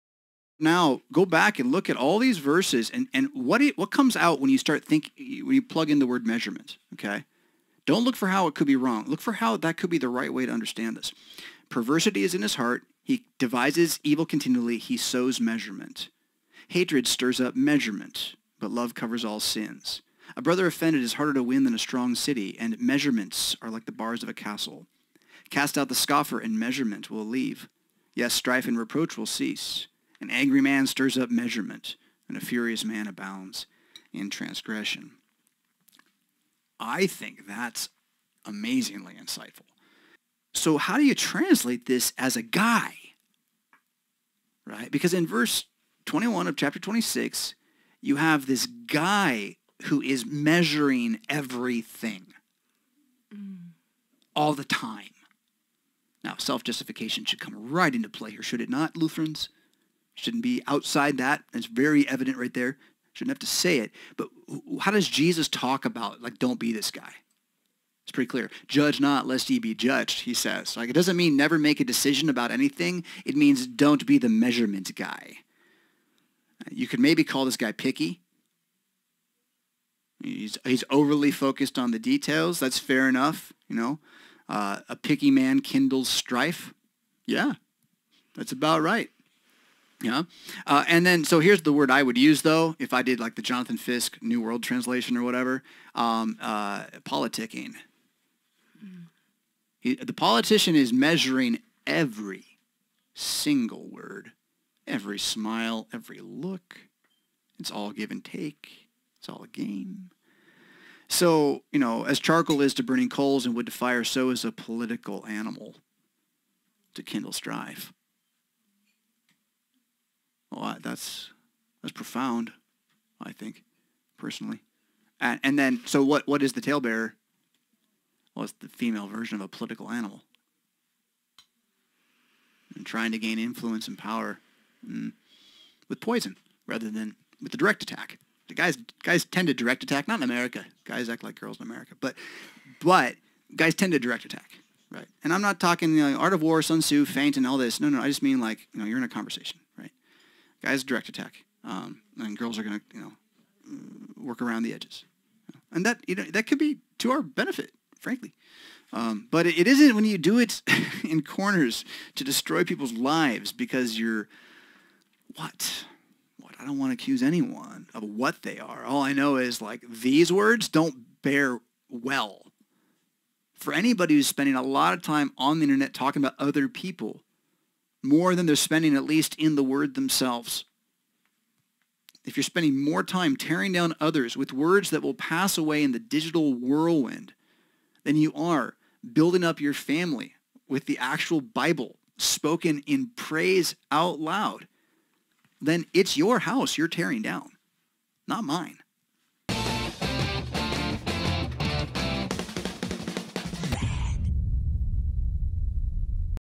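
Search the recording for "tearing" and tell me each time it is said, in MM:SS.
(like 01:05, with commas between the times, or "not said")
03:03, 03:16.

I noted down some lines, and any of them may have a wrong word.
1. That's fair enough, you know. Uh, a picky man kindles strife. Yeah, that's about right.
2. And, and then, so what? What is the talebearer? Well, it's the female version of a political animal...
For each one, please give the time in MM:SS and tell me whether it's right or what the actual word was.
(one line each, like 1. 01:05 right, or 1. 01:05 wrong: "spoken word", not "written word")
1. 01:22 right
2. 02:05 right.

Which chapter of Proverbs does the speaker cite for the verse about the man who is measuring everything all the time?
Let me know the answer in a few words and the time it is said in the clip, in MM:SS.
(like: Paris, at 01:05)
26, at 00:46.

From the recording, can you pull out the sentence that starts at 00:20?
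A brother offended is harder to win than a strong city, and measurements are like the bars of a castle.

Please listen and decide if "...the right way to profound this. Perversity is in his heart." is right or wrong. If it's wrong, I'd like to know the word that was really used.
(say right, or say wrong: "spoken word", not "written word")
wrong: "understand", not "profound".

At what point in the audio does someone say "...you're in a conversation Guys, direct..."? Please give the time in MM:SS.
02:28.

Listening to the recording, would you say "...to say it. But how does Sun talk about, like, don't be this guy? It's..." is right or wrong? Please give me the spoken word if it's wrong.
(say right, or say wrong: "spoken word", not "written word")
wrong: "Jesus", not "Sun".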